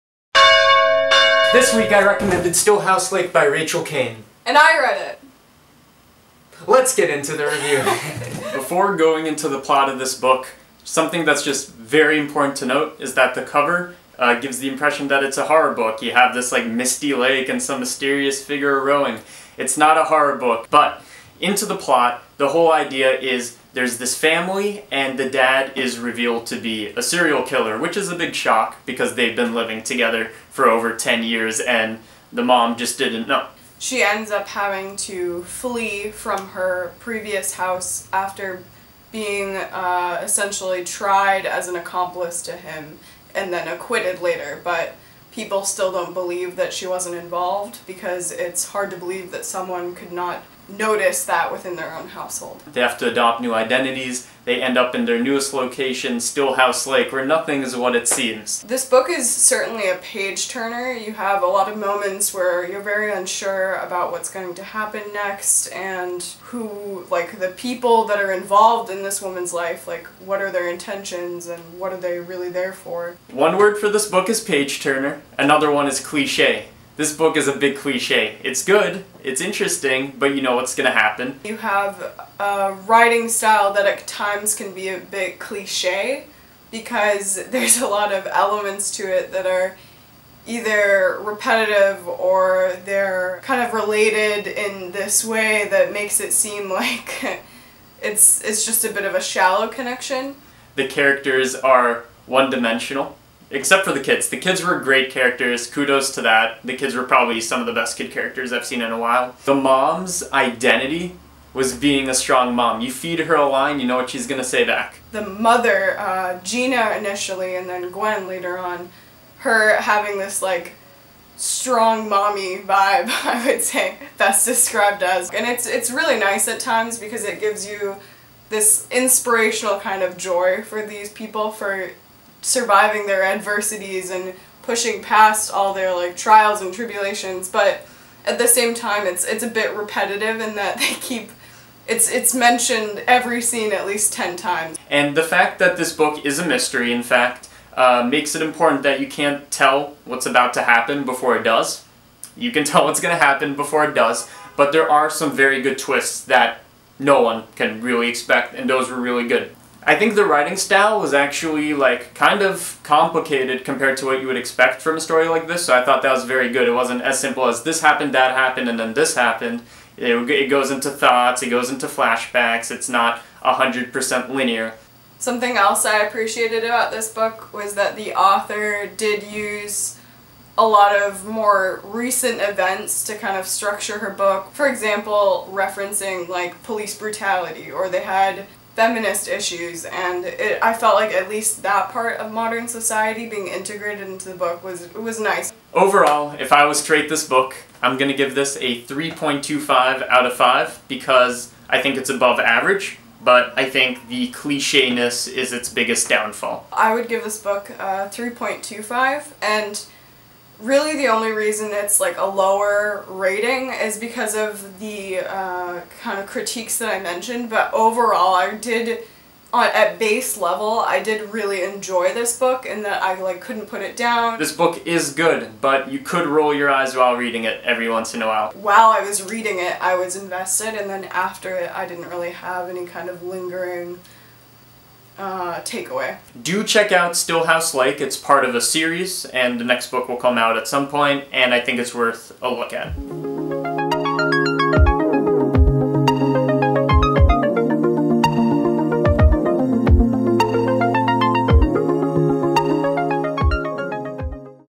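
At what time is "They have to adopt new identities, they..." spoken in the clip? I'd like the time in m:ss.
0:52.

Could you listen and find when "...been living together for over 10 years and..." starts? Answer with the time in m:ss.
0:29.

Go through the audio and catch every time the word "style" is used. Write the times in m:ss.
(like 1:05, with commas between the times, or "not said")
1:23, 2:40.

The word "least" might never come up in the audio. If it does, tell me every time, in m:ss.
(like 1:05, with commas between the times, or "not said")
2:23, 3:11.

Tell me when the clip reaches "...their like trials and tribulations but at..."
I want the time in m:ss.
2:15.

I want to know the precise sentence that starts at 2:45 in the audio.
So I thought that was very good.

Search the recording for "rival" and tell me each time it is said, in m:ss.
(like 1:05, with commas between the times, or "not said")
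not said.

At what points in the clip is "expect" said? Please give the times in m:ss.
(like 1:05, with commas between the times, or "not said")
2:38, 2:44.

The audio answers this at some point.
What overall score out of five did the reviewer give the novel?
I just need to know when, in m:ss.
3:18.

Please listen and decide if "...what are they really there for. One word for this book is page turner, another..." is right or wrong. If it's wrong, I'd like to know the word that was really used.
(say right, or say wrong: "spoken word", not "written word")
right.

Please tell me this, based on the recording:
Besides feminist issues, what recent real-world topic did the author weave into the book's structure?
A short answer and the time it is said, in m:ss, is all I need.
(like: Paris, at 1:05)
police brutality, at 3:06.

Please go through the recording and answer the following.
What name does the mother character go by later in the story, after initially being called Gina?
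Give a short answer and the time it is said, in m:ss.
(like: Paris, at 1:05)
Gwen, at 1:57.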